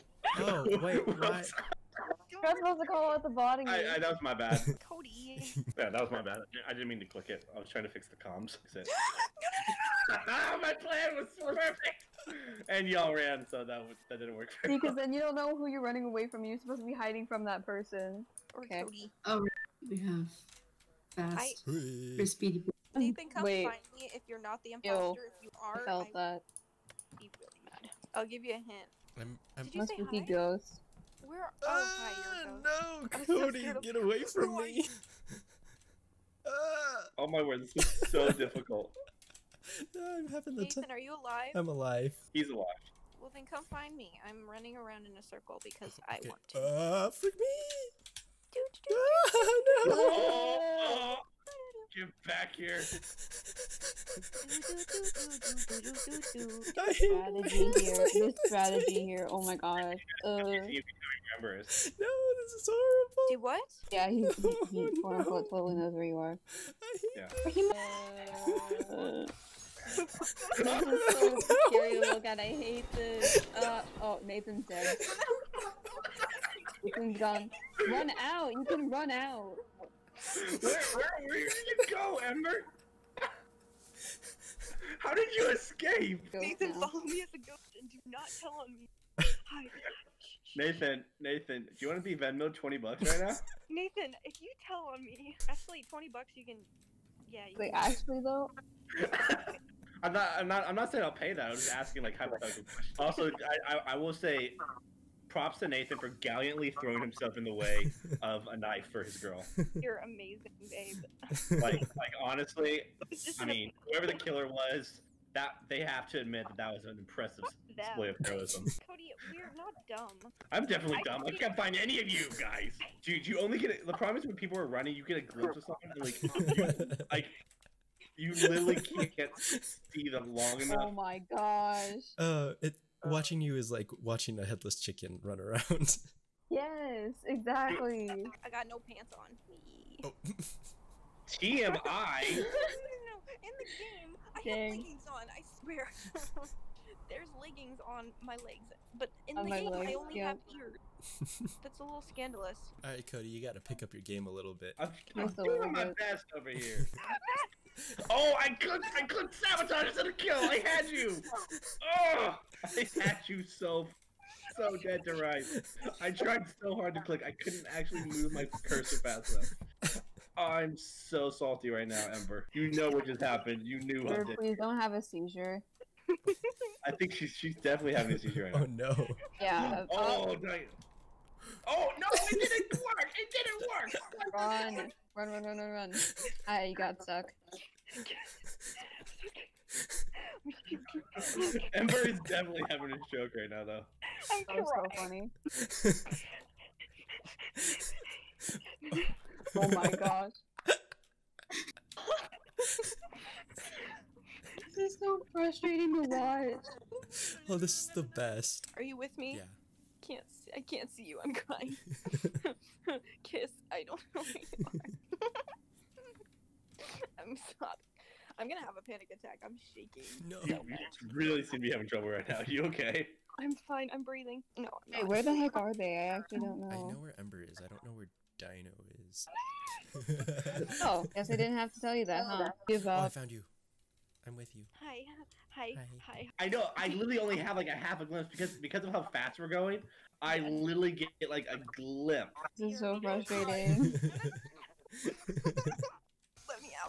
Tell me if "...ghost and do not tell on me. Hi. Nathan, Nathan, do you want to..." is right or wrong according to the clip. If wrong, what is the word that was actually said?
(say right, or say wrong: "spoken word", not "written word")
right.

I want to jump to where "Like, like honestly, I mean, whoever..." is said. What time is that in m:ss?
1:51.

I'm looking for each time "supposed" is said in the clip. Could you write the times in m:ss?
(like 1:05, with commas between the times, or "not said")
0:02, 0:16.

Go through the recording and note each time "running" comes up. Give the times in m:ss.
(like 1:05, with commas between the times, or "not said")
0:15, 0:44, 2:04.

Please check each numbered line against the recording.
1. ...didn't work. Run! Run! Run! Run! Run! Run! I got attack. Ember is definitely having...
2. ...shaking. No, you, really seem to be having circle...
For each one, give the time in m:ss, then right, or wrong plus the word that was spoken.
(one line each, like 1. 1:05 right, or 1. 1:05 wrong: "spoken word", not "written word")
1. 3:03 wrong: "stuck", not "attack"
2. 3:39 wrong: "trouble", not "circle".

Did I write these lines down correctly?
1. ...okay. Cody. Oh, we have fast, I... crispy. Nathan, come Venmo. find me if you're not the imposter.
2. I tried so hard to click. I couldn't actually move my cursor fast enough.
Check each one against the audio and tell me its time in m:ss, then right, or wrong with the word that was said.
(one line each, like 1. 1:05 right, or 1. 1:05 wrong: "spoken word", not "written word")
1. 0:18 wrong: "Wait", not "Venmo"
2. 2:46 right.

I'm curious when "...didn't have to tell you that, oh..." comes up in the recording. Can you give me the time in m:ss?
3:51.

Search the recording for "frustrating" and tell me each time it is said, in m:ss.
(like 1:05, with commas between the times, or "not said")
3:25, 4:03.